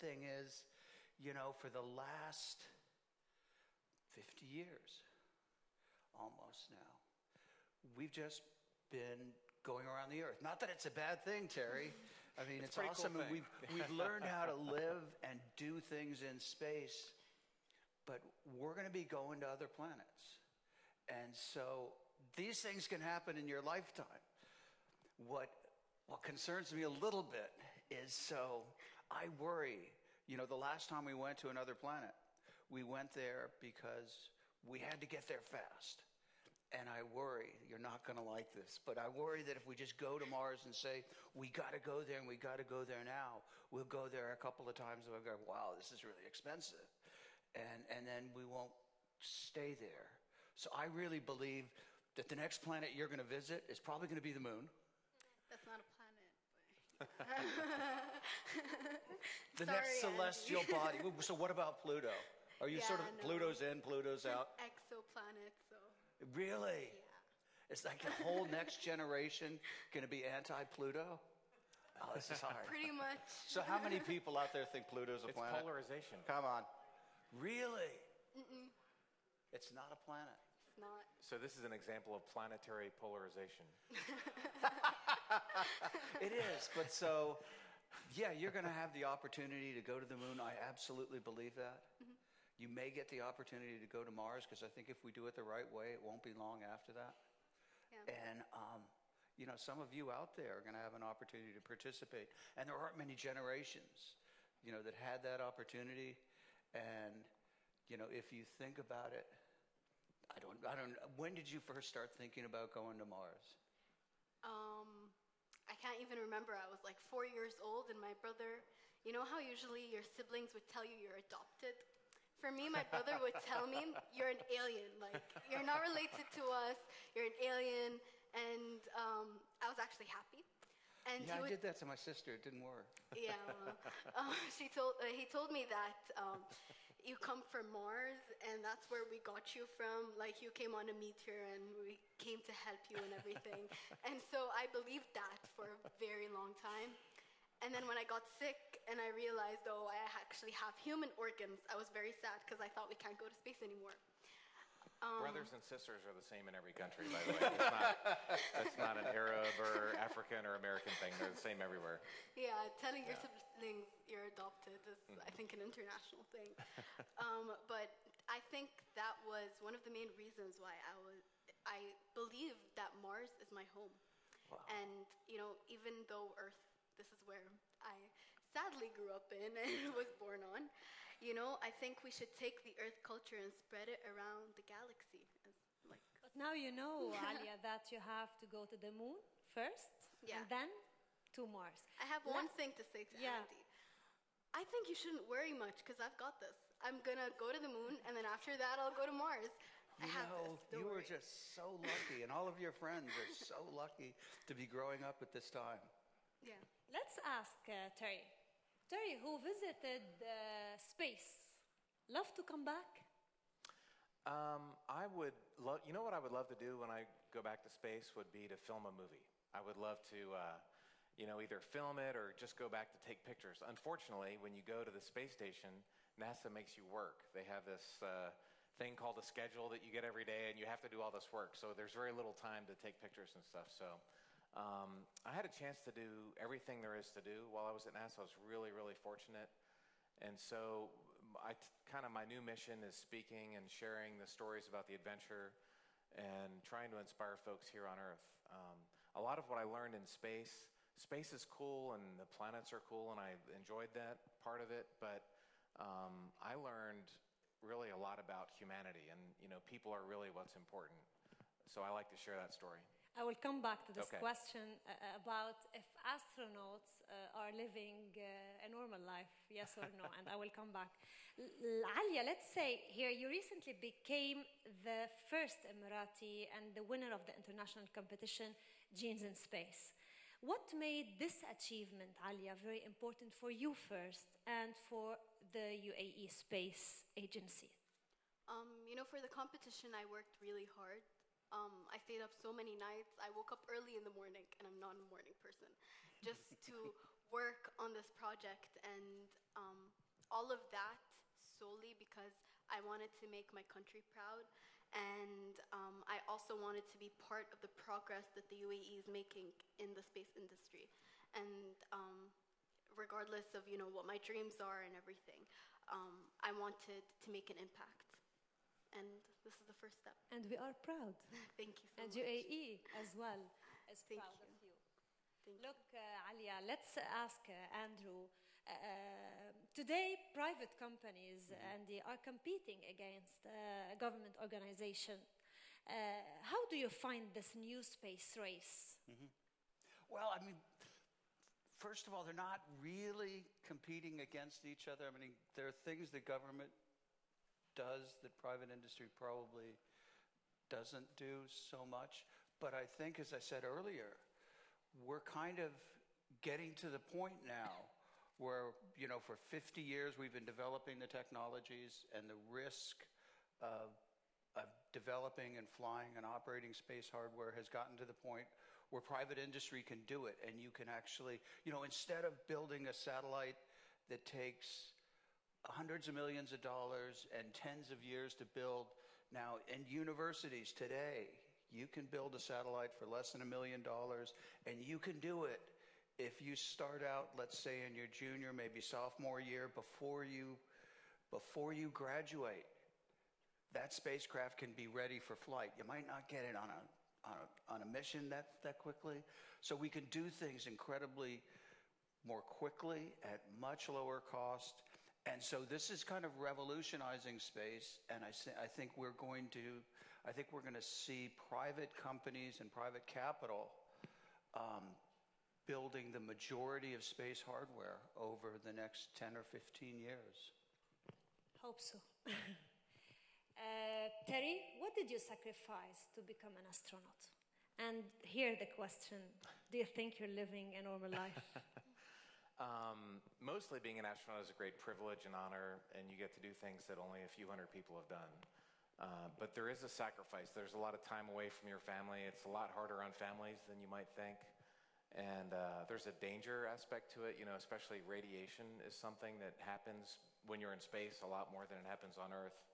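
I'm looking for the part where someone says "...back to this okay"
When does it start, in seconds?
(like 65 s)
263 s.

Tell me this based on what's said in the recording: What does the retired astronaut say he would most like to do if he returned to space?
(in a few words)
film a movie.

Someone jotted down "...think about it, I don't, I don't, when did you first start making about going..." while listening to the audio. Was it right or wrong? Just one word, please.
wrong.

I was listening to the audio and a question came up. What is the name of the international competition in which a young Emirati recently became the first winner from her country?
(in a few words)
Genes in Space.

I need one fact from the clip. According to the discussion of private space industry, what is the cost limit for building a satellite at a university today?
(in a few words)
less than a million dollars.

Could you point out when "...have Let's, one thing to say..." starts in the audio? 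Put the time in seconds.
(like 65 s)
192 s.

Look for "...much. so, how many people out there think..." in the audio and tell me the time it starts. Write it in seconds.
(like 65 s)
72 s.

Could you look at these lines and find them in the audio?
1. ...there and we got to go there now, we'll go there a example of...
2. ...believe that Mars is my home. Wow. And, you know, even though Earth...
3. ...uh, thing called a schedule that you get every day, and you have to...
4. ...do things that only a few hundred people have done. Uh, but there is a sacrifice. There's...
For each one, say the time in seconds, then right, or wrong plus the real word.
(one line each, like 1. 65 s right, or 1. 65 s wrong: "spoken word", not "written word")
1. 42 s wrong: "couple", not "example"
2. 172 s right
3. 228 s right
4. 436 s right.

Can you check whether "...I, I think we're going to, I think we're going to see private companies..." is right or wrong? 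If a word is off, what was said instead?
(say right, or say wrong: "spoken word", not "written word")
right.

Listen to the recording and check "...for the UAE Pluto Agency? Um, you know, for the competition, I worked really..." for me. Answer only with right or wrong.
wrong.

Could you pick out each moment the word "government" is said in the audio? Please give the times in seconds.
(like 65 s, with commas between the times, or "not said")
334 s, 346 s.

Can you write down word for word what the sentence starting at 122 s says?
For me, my brother would tell me, "You're an alien.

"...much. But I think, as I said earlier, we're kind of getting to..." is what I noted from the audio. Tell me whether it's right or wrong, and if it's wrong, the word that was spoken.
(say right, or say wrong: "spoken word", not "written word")
right.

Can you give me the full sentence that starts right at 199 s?
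You know, you were just so lucky, and all of your friends are so lucky to be growing up at this time.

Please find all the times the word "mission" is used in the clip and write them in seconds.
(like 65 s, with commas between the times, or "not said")
242 s, 397 s.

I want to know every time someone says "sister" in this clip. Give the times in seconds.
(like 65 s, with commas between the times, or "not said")
131 s, 155 s.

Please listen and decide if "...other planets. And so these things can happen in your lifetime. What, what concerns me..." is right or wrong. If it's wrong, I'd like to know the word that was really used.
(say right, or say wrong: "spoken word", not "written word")
right.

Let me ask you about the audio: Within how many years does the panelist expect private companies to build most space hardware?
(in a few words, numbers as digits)
10 or 15 years.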